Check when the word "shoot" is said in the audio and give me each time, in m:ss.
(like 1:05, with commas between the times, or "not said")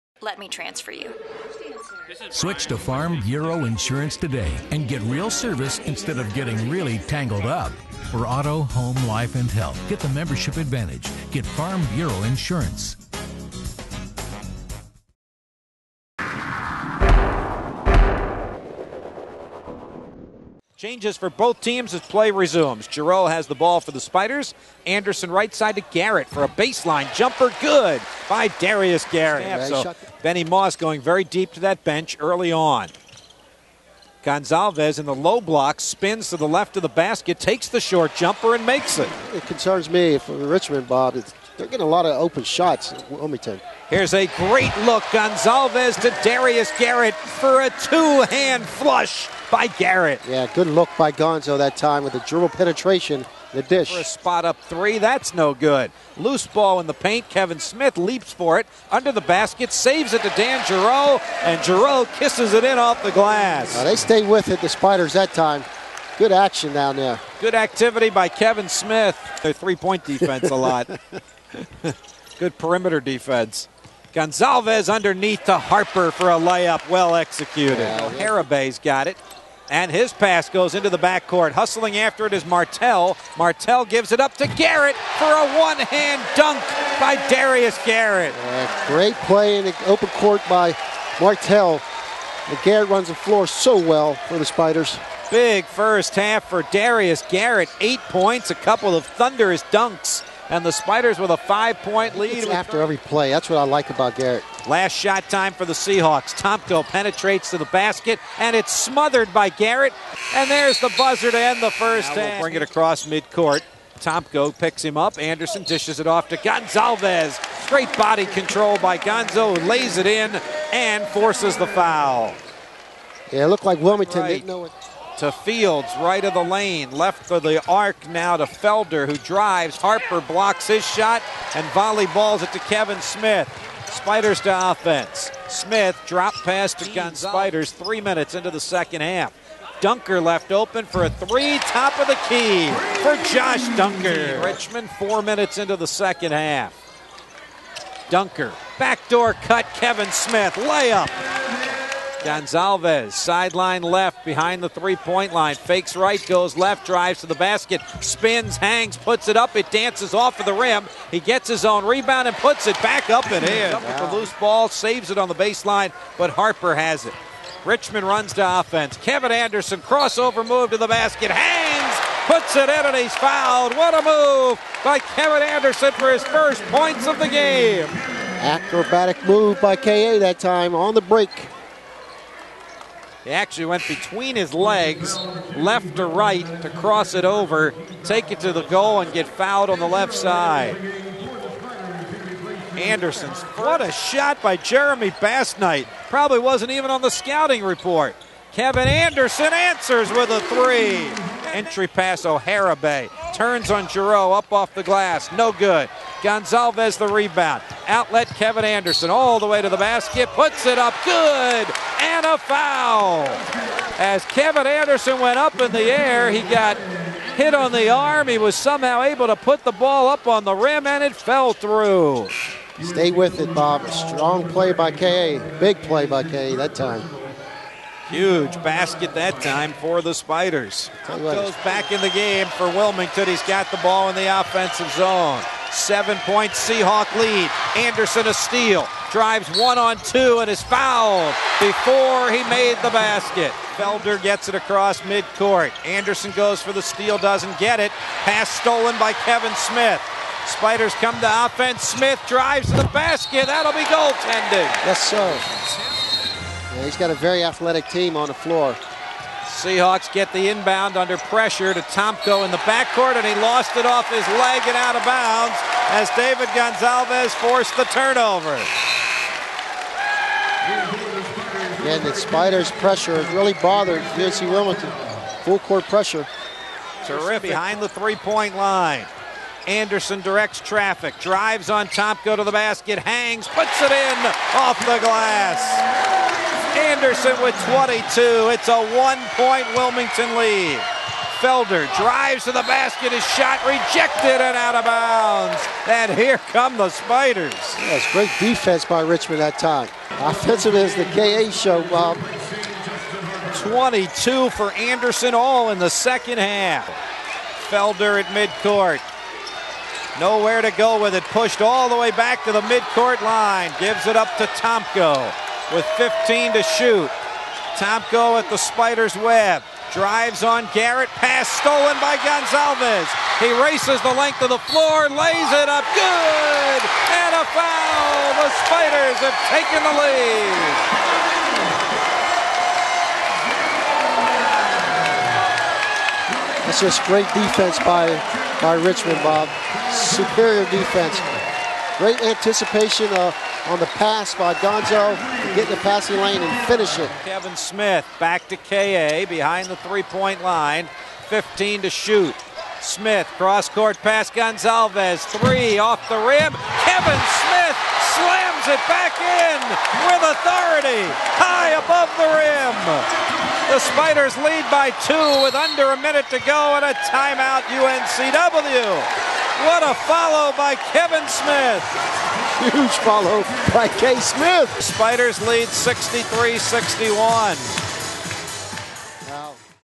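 5:16, 5:51.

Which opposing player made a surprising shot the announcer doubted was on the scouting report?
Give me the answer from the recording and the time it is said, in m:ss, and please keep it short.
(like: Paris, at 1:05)
Jeremy Bassnight, at 3:14.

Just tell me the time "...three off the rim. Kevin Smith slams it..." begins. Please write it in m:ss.
5:55.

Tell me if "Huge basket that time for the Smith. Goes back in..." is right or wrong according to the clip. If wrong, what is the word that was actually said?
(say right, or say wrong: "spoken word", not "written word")
wrong: "Spiders", not "Smith".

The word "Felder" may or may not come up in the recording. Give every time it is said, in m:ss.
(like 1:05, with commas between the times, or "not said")
2:08, 4:03, 4:51, 5:07.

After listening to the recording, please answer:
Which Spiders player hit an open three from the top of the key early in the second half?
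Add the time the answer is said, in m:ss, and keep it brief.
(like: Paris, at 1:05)
Josh Duinker, at 2:23.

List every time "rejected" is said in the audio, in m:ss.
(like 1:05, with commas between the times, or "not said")
4:53.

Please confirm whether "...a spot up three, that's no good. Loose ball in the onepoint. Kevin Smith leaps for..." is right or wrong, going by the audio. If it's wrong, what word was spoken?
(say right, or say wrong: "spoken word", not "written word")
wrong: "paint", not "onepoint".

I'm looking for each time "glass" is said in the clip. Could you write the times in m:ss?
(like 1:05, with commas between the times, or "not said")
1:03, 3:24, 4:45.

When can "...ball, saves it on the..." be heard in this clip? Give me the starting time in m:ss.
2:44.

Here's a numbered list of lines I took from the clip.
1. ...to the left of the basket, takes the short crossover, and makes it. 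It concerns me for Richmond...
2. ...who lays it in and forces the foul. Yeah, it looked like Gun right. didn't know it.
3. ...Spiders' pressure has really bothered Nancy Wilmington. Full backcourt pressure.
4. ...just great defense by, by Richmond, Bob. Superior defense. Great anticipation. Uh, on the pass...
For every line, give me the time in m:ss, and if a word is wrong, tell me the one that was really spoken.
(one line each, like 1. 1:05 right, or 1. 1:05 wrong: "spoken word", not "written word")
1. 0:36 wrong: "jumper", not "crossover"
2. 1:59 wrong: "Wilmington", not "Gun"
3. 4:32 wrong: "court", not "backcourt"
4. 5:36 right.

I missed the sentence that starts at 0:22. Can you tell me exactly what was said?
Giroux has the ball for the Spiders.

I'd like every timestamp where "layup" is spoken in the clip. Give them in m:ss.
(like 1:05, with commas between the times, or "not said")
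1:16, 2:30.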